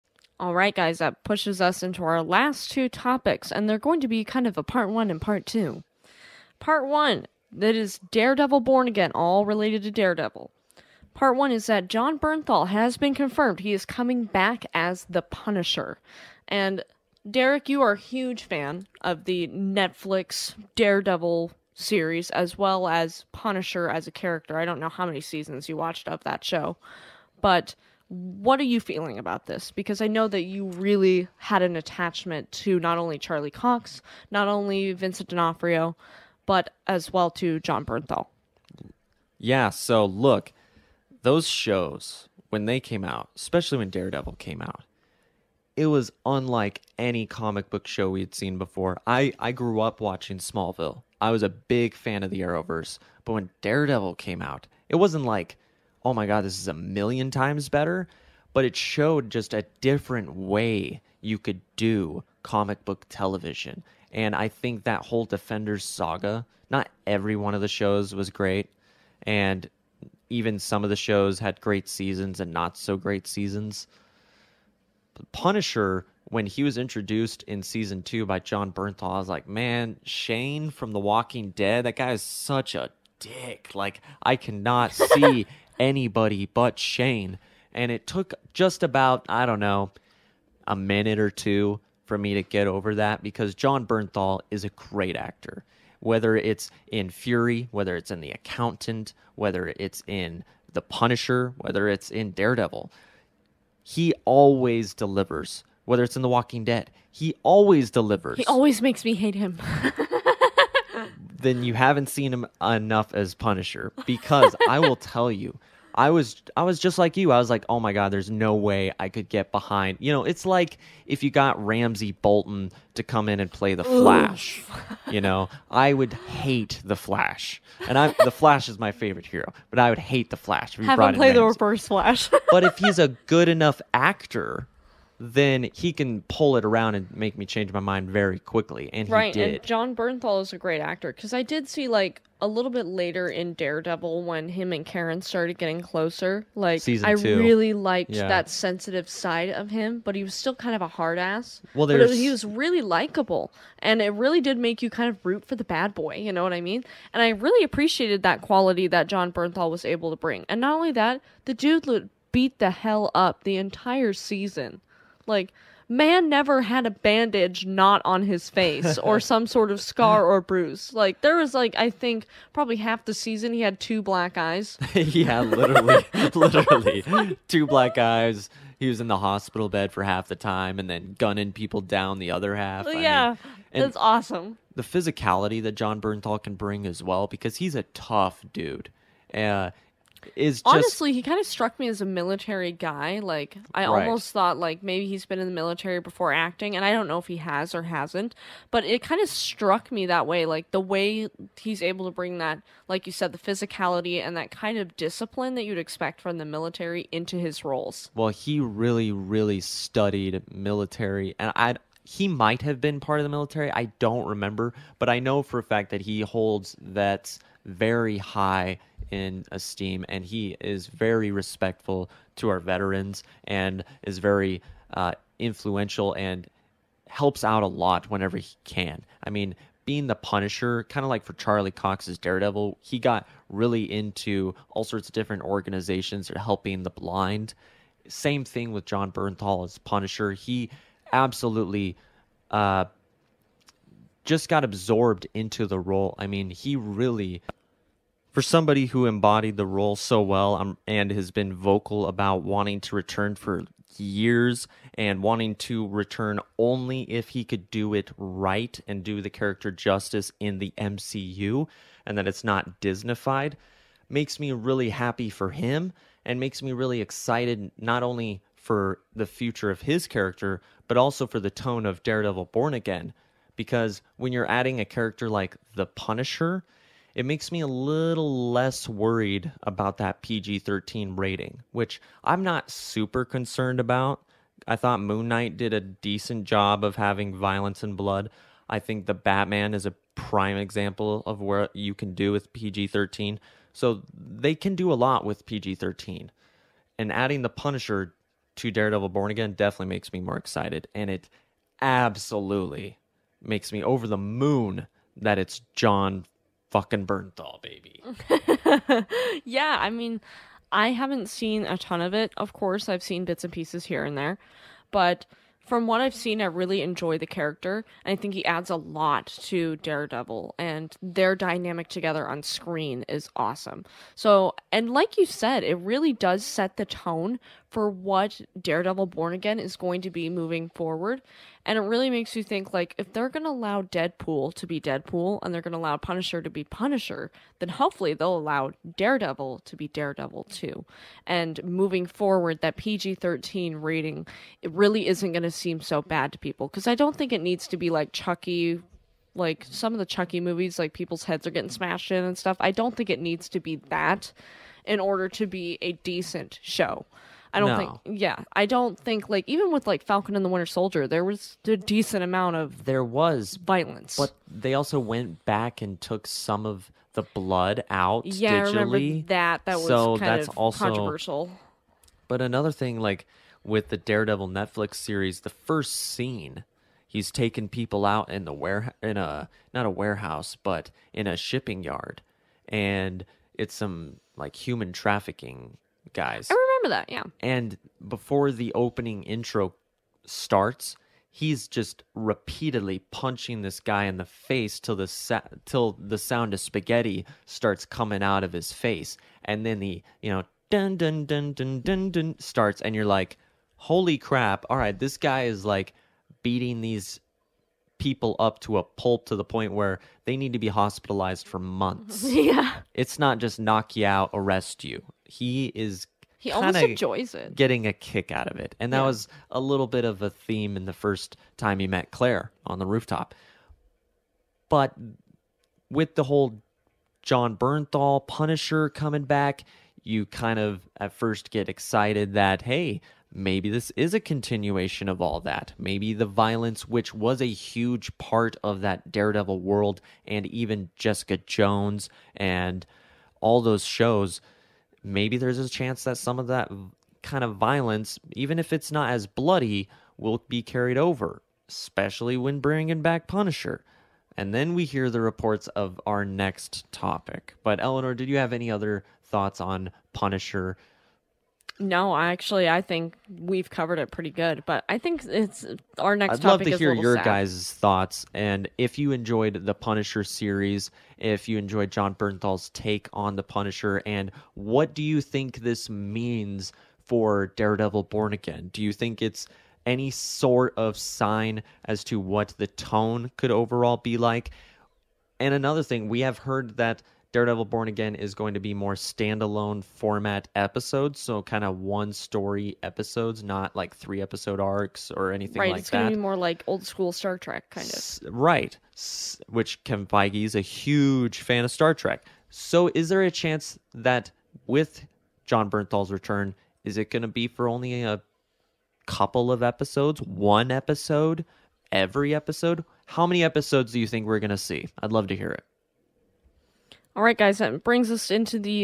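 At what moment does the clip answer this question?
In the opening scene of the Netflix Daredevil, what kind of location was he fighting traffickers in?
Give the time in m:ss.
6:21.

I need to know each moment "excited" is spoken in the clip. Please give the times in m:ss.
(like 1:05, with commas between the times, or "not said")
4:27, 5:00, 7:11.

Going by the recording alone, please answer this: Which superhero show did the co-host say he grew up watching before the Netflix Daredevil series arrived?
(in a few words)
Smallville.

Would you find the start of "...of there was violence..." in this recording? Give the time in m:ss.
6:02.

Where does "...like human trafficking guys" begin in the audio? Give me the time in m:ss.
6:24.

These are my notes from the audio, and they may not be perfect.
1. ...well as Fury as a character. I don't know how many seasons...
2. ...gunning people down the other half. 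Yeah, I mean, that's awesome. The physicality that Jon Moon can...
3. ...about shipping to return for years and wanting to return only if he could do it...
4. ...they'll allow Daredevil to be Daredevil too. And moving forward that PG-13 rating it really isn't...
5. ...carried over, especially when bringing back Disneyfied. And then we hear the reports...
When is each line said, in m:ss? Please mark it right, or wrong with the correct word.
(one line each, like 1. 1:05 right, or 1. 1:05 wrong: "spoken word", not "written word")
1. 0:22 wrong: "Punisher", not "Fury"
2. 3:01 wrong: "Bernthal", not "Moon"
3. 4:12 wrong: "wanting", not "shipping"
4. 5:38 right
5. 7:30 wrong: "Punisher", not "Disneyfied".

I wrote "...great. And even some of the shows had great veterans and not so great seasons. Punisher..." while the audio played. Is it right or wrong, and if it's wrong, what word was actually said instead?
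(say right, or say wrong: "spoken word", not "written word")
wrong: "seasons", not "veterans".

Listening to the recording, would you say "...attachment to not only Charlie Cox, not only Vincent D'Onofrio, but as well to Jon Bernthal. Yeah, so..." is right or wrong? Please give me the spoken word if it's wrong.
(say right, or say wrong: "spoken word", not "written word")
right.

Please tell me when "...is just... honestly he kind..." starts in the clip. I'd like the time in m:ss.
3:10.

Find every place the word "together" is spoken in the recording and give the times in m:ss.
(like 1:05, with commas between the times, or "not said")
5:21.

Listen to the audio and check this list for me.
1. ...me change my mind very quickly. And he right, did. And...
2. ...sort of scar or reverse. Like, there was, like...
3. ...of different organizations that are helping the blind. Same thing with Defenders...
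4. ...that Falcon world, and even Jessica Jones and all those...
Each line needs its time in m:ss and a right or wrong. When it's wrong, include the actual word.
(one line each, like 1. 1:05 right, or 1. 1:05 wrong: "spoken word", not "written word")
1. 2:17 right
2. 2:49 wrong: "bruise", not "reverse"
3. 3:55 wrong: "Jon", not "Defenders"
4. 7:18 wrong: "Daredevil", not "Falcon".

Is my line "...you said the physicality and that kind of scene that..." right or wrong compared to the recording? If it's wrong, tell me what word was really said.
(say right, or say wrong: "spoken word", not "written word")
wrong: "discipline", not "scene".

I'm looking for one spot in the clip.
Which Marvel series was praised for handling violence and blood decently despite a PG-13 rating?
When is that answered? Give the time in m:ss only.
4:45.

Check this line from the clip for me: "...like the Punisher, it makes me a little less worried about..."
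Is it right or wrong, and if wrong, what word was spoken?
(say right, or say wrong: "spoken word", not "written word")
right.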